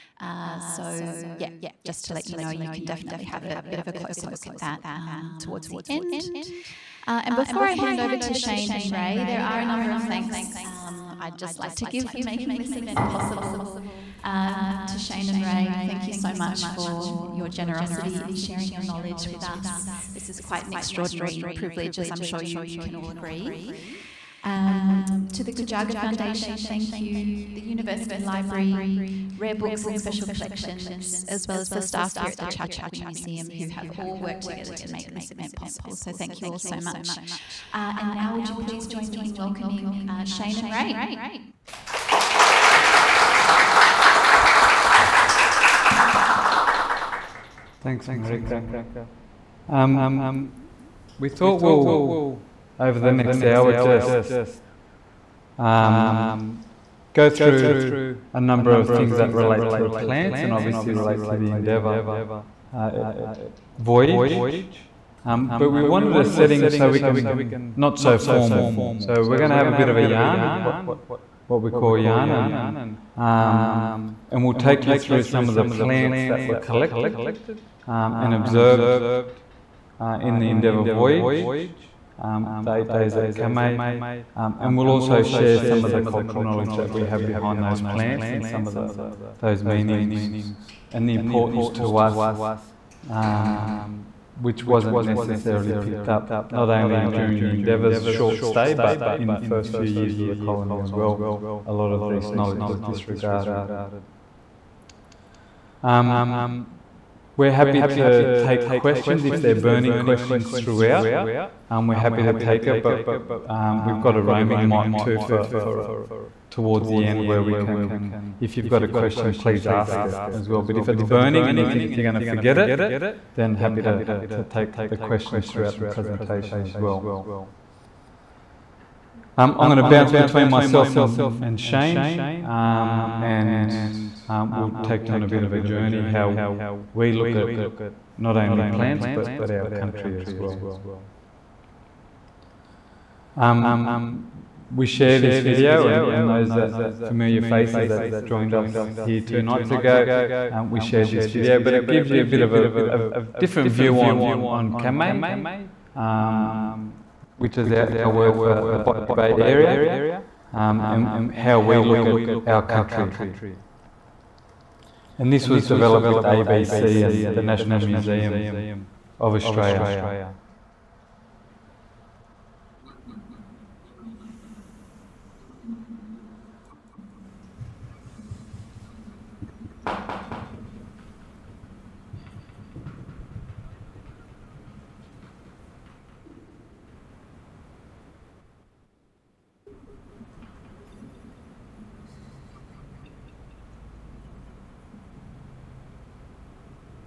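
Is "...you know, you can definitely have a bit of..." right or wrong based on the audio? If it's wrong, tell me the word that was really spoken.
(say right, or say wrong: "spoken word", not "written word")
right.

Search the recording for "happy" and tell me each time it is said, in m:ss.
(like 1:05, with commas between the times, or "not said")
1:47, 1:51, 2:03.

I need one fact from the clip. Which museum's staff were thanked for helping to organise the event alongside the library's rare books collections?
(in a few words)
Chau Chak Wing Museum.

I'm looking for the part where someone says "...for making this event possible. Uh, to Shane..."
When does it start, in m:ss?
0:12.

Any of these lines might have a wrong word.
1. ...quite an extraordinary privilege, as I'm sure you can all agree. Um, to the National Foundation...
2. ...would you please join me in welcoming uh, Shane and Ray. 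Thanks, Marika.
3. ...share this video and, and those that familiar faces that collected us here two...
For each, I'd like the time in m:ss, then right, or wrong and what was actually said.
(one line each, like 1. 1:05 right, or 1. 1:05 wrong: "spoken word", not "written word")
1. 0:20 wrong: "Gujaga", not "National"
2. 0:38 right
3. 2:24 wrong: "joined", not "collected".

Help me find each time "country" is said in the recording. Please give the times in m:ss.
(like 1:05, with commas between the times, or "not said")
2:19, 2:42.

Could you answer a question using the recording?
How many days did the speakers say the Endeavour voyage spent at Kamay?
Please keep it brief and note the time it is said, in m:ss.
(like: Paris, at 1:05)
8, at 1:22.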